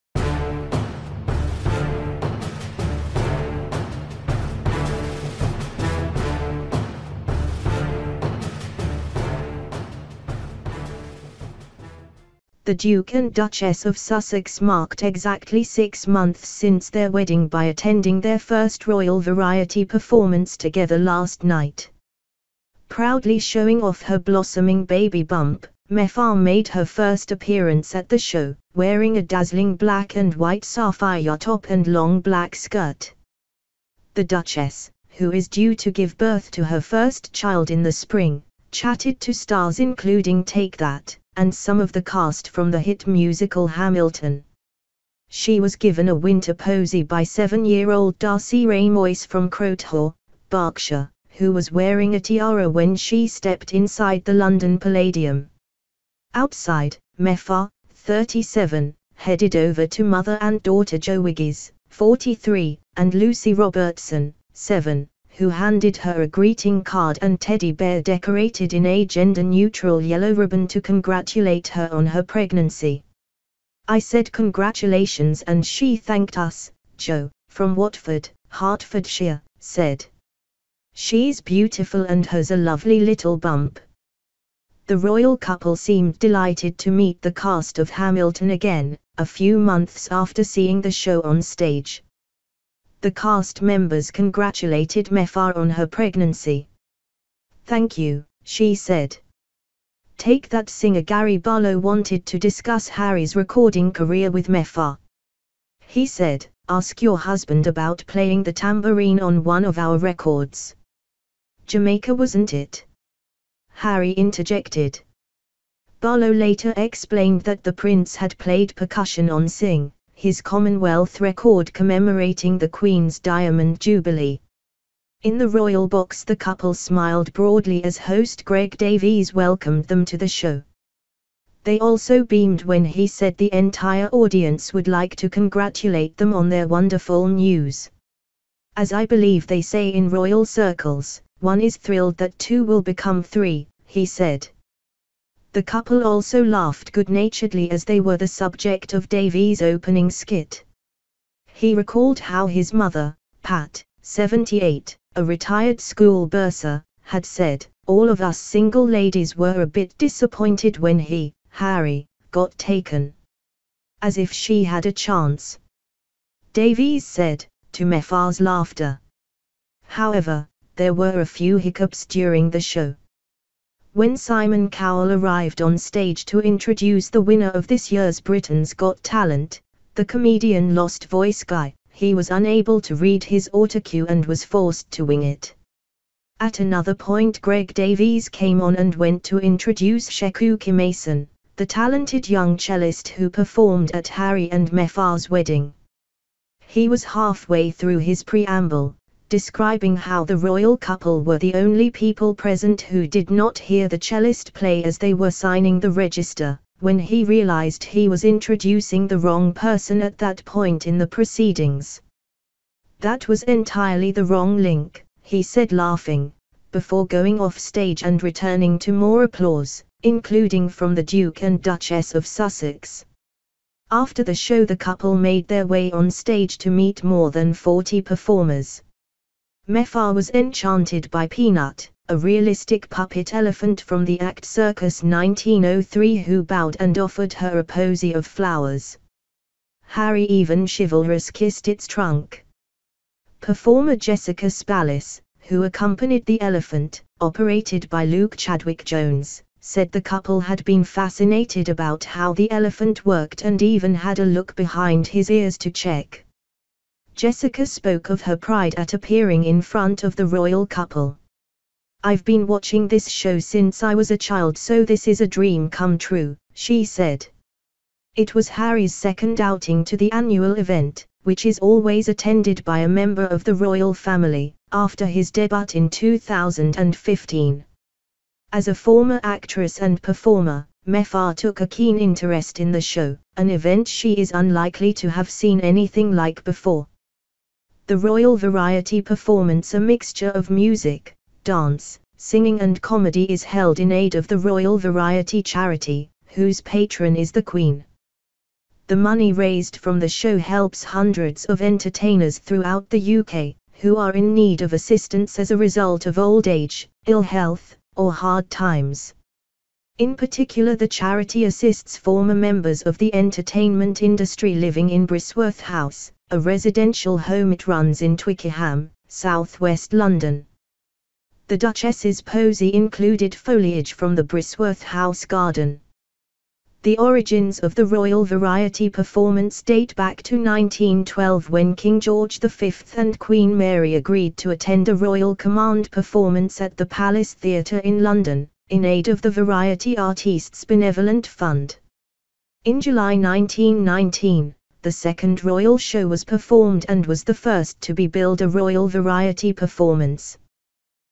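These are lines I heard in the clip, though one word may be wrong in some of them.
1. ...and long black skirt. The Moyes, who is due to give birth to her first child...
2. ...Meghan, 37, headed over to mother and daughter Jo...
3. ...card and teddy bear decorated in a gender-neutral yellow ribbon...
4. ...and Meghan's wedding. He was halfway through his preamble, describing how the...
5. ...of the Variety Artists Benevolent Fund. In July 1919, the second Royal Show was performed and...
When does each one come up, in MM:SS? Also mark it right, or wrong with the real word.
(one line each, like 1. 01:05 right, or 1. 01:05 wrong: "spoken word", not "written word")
1. 00:31 wrong: "Duchess", not "Moyes"
2. 00:57 right
3. 01:06 right
4. 03:14 right
5. 05:39 right.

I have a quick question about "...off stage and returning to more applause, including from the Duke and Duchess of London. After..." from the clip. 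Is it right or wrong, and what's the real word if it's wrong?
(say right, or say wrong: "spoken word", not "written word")
wrong: "Sussex", not "London".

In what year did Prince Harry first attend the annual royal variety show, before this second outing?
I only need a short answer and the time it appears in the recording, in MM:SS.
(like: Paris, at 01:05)
2015, at 04:35.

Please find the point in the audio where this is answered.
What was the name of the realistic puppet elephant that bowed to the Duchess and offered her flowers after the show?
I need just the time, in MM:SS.
03:51.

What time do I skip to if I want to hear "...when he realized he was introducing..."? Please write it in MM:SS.
03:26.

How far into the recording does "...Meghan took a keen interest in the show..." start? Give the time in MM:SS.
04:40.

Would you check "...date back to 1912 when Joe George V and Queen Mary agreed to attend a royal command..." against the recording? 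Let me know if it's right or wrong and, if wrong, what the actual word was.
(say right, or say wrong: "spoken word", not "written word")
wrong: "King", not "Joe".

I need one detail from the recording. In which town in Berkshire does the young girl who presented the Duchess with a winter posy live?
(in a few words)
Crowthorne.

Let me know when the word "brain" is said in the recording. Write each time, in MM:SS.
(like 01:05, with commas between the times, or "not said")
not said.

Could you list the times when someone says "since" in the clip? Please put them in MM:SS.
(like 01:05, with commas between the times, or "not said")
00:16, 04:23.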